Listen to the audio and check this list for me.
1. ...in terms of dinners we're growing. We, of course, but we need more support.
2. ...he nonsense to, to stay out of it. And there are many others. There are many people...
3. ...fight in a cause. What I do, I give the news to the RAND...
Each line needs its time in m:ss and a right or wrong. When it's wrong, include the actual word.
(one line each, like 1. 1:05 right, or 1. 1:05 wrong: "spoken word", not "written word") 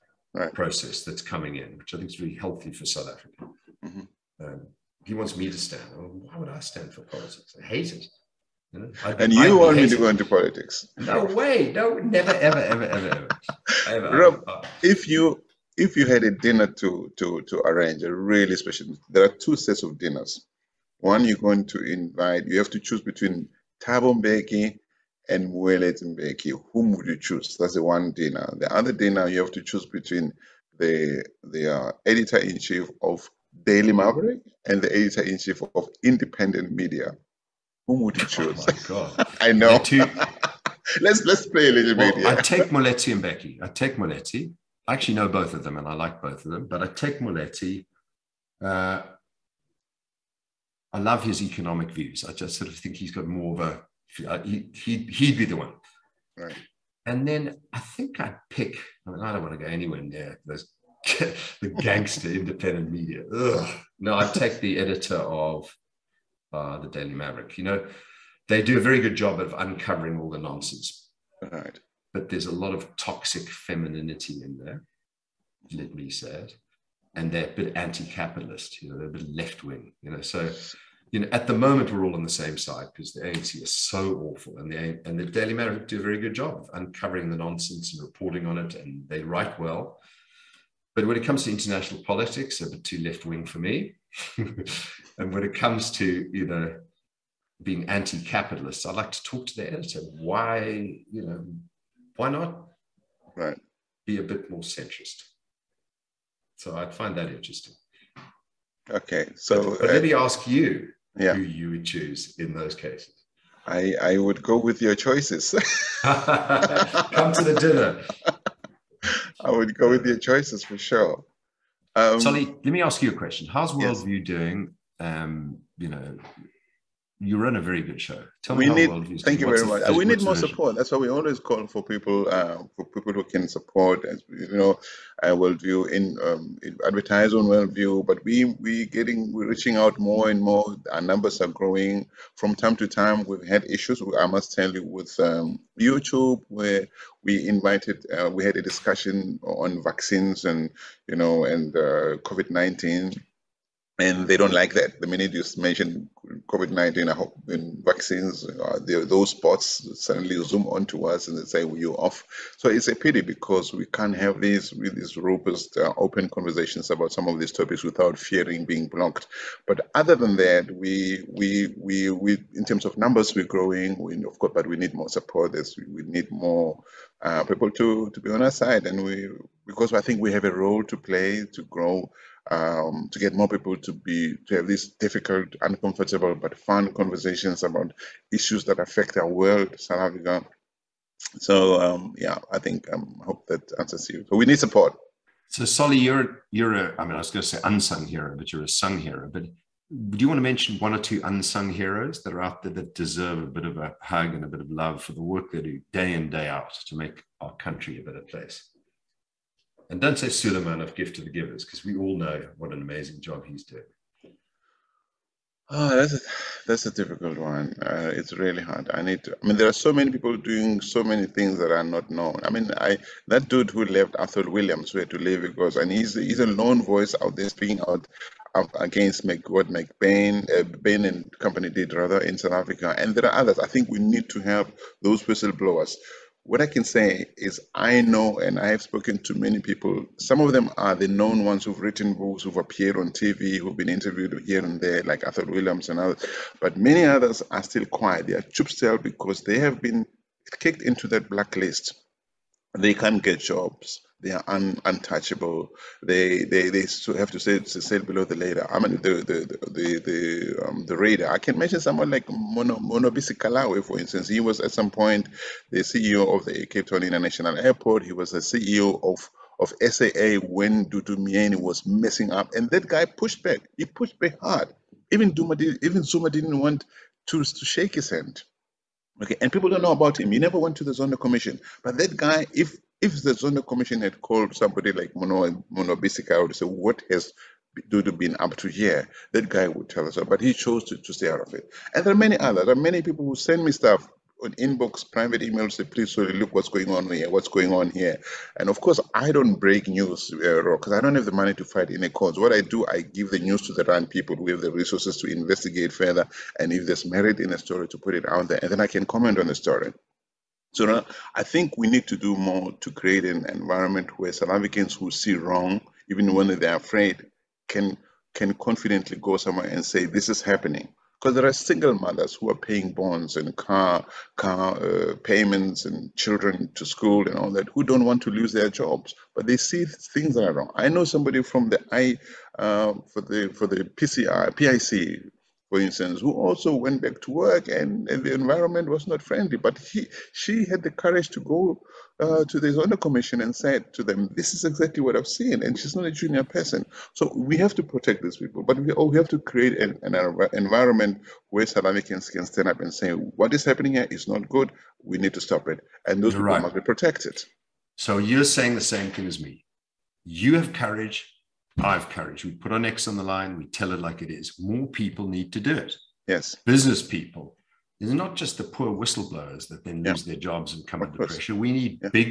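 1. 2:52 wrong: "numbers", not "dinners"
2. 4:50 wrong: "chose", not "nonsense"
3. 5:01 right.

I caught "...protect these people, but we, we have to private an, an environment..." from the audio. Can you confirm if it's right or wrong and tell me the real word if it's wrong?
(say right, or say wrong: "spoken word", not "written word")
wrong: "create", not "private".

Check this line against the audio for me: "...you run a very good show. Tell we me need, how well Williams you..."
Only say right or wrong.
wrong.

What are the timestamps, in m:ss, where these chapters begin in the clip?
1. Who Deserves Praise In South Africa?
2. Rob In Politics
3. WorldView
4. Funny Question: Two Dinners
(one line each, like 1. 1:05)
1. 3:23
2. 0:11
3. 2:05
4. 0:34.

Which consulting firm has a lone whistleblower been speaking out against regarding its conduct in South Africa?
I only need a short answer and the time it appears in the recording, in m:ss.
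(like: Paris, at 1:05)
Bain and company, at 3:50.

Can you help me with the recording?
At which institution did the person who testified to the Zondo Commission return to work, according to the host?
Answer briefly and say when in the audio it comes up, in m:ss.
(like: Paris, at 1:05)
PIC, at 5:34.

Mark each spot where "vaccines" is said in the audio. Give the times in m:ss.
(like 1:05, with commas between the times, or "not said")
2:29, 2:37.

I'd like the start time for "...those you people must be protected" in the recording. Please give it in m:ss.
5:56.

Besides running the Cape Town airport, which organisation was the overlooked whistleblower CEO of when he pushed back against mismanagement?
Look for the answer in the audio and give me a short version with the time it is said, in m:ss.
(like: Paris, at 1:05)
SAA, at 4:29.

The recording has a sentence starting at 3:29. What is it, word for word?
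And don't say of gift to the givers, because we all know what an amazing job he's doing.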